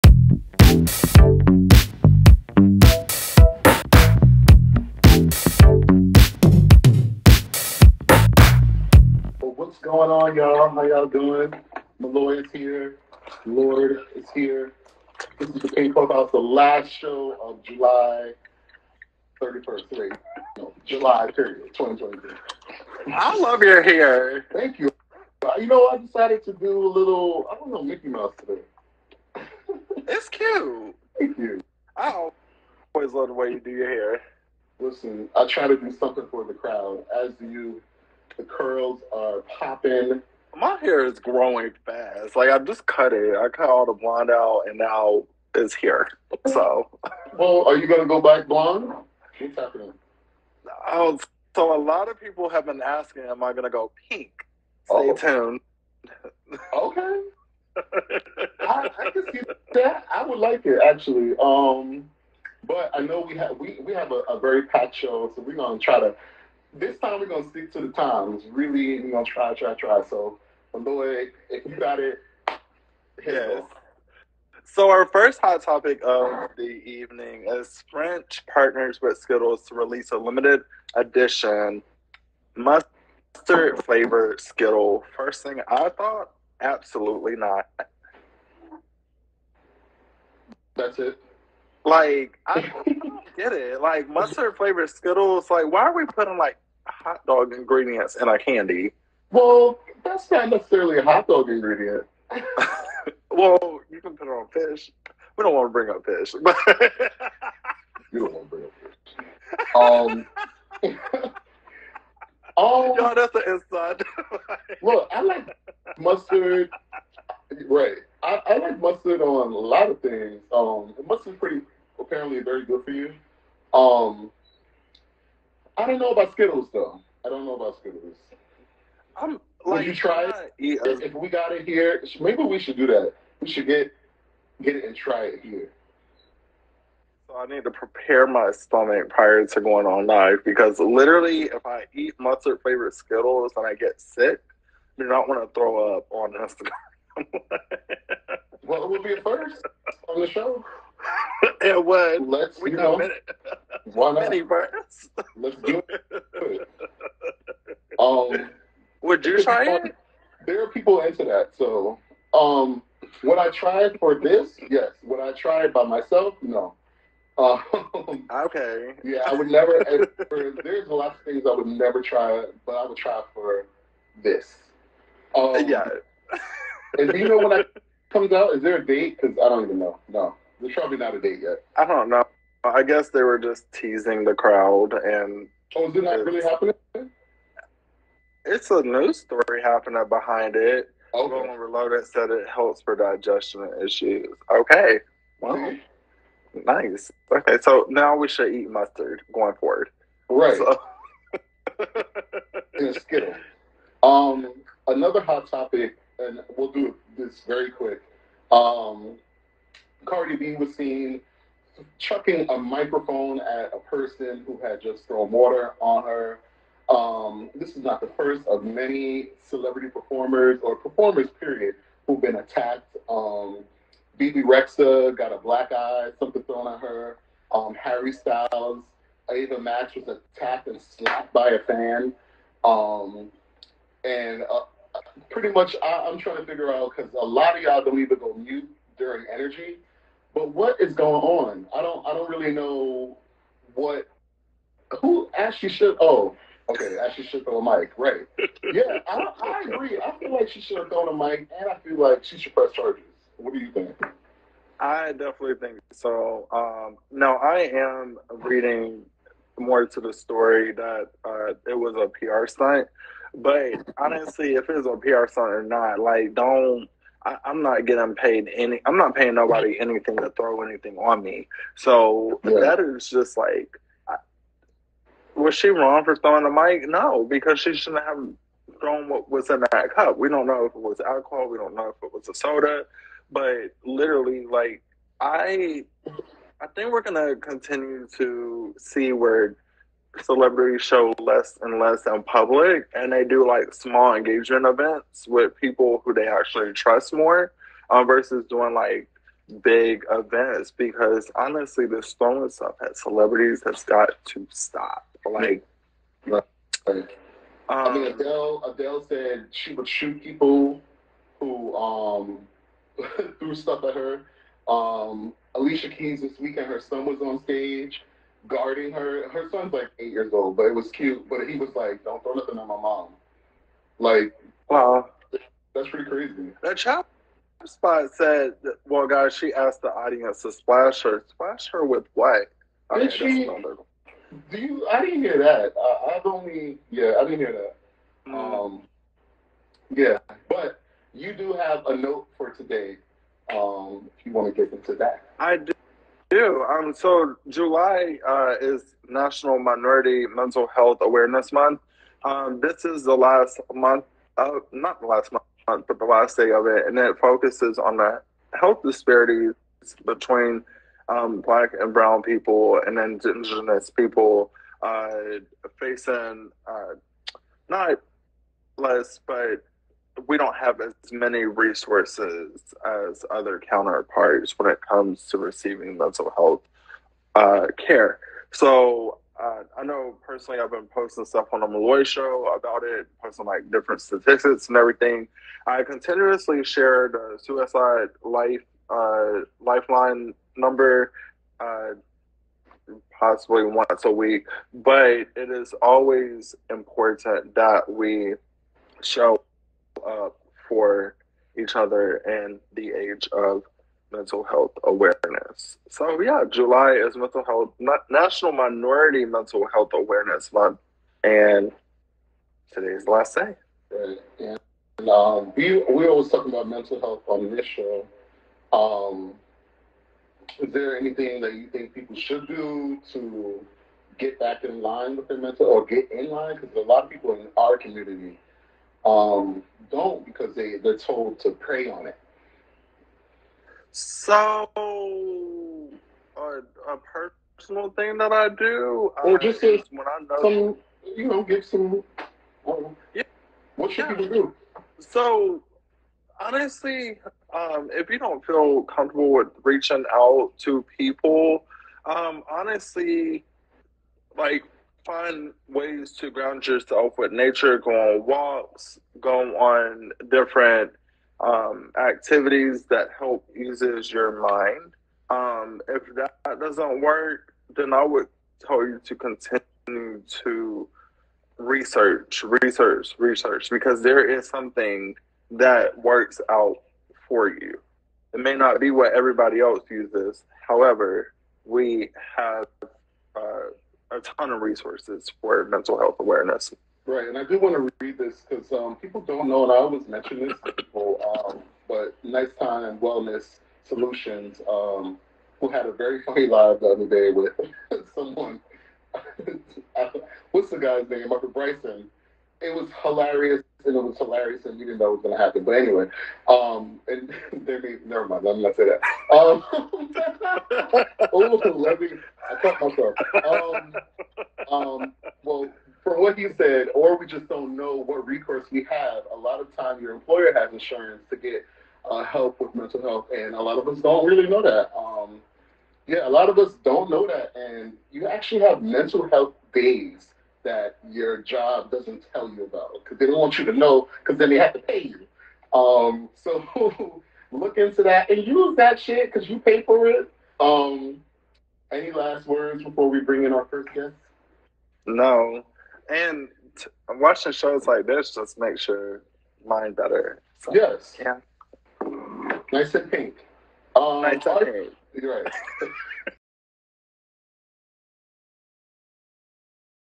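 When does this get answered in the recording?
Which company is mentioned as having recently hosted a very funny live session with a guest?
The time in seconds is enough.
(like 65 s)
492 s.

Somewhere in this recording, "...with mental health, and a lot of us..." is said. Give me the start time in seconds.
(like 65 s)
522 s.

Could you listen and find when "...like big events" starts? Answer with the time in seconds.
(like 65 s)
298 s.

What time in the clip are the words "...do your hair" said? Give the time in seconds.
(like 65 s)
33 s.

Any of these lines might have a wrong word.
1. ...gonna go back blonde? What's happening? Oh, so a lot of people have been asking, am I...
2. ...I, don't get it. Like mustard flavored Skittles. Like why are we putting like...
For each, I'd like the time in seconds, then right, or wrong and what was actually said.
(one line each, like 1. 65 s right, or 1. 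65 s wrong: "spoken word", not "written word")
1. 47 s right
2. 92 s right.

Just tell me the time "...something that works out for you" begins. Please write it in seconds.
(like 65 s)
474 s.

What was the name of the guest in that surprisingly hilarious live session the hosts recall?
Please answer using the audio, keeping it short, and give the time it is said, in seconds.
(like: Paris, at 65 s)
Michael Bryson, at 501 s.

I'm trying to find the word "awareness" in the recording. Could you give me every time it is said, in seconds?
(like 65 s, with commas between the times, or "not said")
351 s, 404 s, 409 s, 486 s.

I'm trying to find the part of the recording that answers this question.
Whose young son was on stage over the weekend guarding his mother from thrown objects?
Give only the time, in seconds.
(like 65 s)
315 s.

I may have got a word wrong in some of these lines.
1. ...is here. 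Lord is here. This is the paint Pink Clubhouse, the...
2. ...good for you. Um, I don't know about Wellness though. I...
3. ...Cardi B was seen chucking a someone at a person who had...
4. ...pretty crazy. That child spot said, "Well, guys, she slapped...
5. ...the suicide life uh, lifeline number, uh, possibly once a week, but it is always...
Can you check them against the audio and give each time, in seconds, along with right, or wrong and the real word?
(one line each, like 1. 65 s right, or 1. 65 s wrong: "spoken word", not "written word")
1. 12 s right
2. 122 s wrong: "Skittles", not "Wellness"
3. 210 s wrong: "microphone", not "someone"
4. 325 s wrong: "asked", not "slapped"
5. 387 s right.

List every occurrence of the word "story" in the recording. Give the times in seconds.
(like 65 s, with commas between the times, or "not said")
189 s, 260 s.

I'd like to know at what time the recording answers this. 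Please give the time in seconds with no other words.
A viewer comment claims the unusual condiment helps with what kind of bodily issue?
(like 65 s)
192 s.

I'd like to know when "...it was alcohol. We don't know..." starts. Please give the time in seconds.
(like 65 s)
280 s.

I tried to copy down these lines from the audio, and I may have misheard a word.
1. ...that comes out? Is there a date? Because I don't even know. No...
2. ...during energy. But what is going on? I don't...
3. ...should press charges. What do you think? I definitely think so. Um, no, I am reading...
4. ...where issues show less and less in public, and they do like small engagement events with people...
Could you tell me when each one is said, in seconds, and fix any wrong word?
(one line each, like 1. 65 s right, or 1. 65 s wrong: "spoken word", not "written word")
1. 177 s right
2. 238 s right
3. 252 s right
4. 289 s wrong: "celebrities", not "issues".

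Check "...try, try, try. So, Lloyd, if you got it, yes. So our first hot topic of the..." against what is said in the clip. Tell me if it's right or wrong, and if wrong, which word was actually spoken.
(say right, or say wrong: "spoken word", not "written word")
right.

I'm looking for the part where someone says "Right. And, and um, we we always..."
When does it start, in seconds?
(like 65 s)
413 s.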